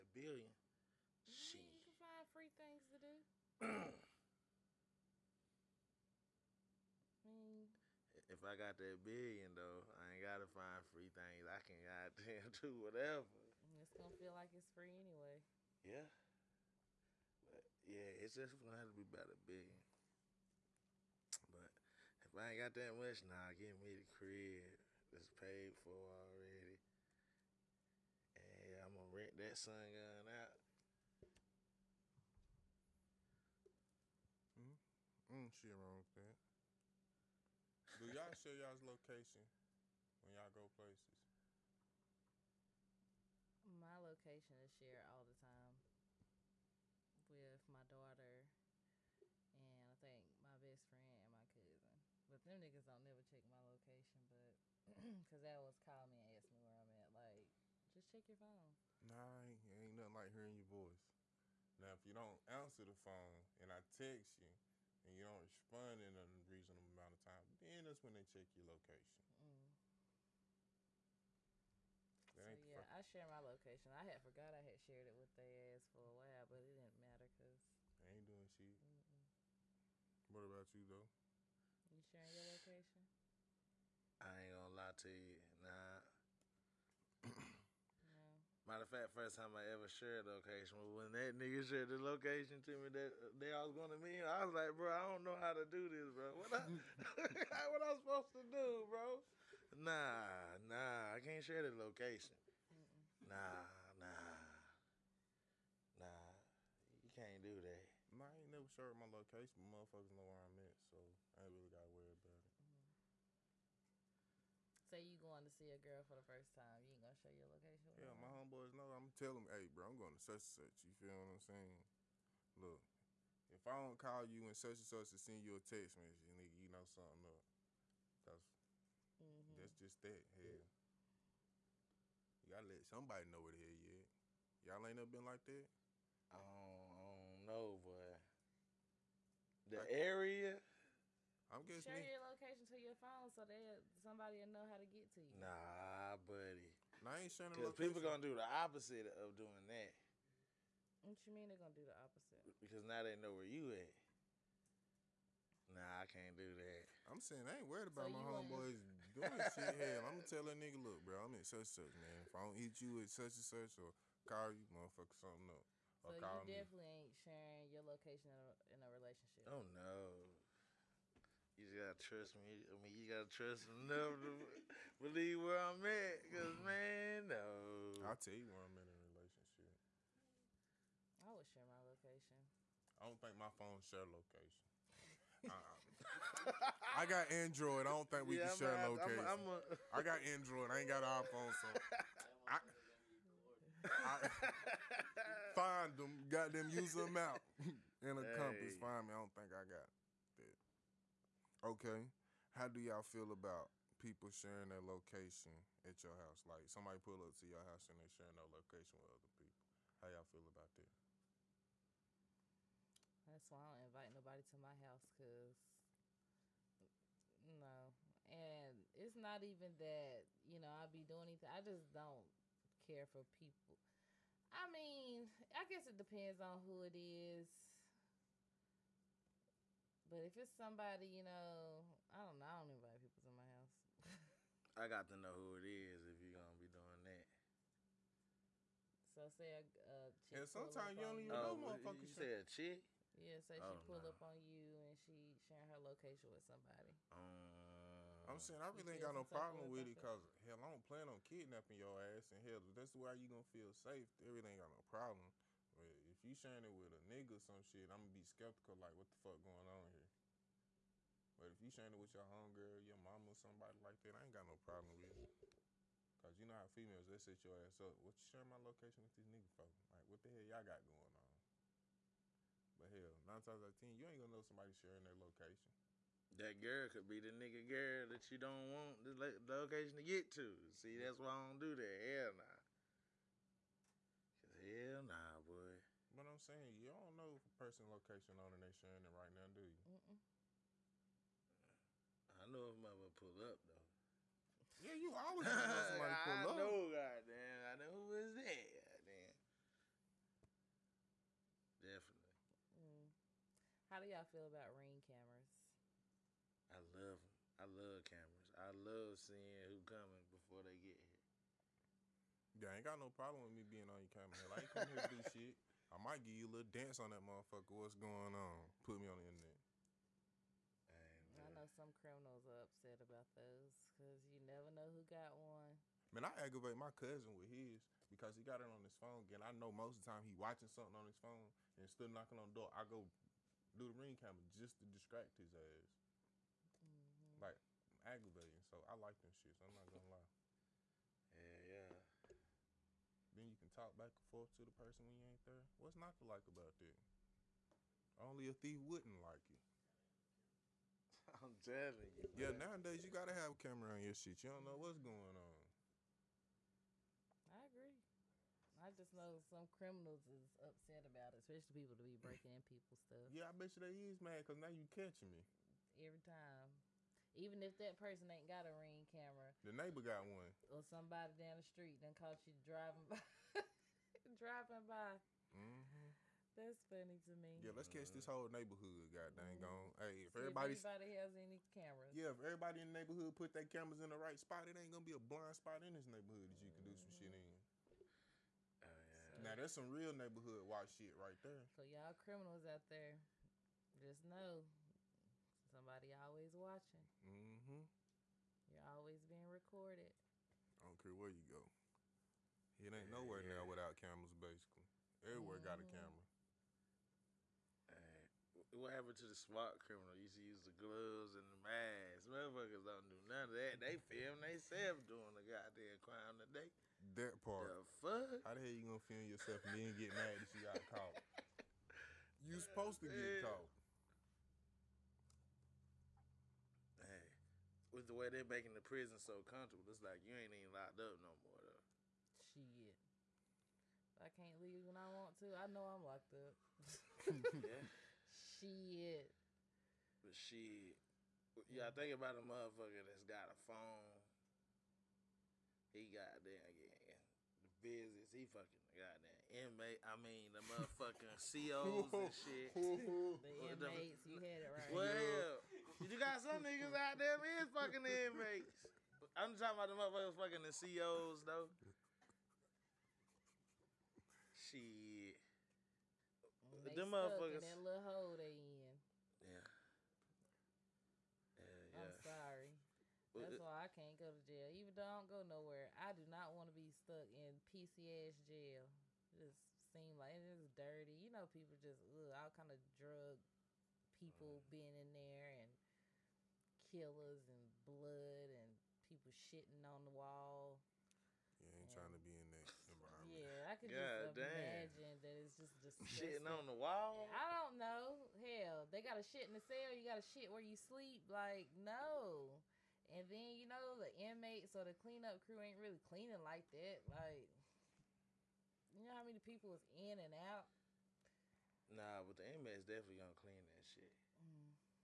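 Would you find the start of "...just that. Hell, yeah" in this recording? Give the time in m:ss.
2:09.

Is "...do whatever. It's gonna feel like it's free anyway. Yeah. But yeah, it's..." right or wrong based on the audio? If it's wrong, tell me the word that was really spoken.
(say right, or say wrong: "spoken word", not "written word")
right.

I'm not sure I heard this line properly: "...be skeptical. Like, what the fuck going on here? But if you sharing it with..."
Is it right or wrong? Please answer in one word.
right.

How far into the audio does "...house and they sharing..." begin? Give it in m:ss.
3:27.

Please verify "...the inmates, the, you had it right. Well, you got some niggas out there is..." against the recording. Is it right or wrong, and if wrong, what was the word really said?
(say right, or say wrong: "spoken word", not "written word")
right.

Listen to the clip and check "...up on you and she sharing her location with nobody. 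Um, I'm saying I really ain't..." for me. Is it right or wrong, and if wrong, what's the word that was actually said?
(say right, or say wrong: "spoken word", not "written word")
wrong: "somebody", not "nobody".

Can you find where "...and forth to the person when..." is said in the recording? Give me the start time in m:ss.
5:44.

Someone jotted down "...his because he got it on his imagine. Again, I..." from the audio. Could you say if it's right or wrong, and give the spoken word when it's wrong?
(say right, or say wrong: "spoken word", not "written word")
wrong: "phone", not "imagine".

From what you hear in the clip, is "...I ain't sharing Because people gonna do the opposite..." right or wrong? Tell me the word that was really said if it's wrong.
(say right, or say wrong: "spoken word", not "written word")
right.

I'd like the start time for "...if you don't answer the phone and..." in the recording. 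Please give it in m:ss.
1:01.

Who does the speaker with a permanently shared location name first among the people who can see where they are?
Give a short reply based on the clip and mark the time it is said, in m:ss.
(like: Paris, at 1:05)
daughter, at 0:47.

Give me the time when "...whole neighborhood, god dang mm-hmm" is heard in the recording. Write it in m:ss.
6:18.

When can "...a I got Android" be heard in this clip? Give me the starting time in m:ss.
3:09.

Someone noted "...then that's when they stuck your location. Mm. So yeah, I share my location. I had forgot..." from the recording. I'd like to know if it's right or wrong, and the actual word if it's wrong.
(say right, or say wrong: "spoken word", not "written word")
wrong: "check", not "stuck".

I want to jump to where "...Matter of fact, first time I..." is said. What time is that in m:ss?
1:28.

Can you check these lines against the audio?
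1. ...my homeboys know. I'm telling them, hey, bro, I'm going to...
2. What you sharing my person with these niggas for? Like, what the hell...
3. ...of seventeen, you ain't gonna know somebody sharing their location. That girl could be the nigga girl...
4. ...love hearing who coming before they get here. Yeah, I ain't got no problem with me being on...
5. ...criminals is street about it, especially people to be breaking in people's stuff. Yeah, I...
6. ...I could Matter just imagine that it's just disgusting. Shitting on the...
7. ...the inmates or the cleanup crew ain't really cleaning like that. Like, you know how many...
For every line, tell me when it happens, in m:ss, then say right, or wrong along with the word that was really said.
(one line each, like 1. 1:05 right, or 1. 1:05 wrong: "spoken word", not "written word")
1. 1:58 right
2. 4:27 wrong: "location", not "person"
3. 4:33 wrong: "ten", not "seventeen"
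4. 5:08 wrong: "seeing", not "hearing"
5. 5:59 wrong: "upset", not "street"
6. 8:13 wrong: "God", not "Matter"
7. 8:23 right.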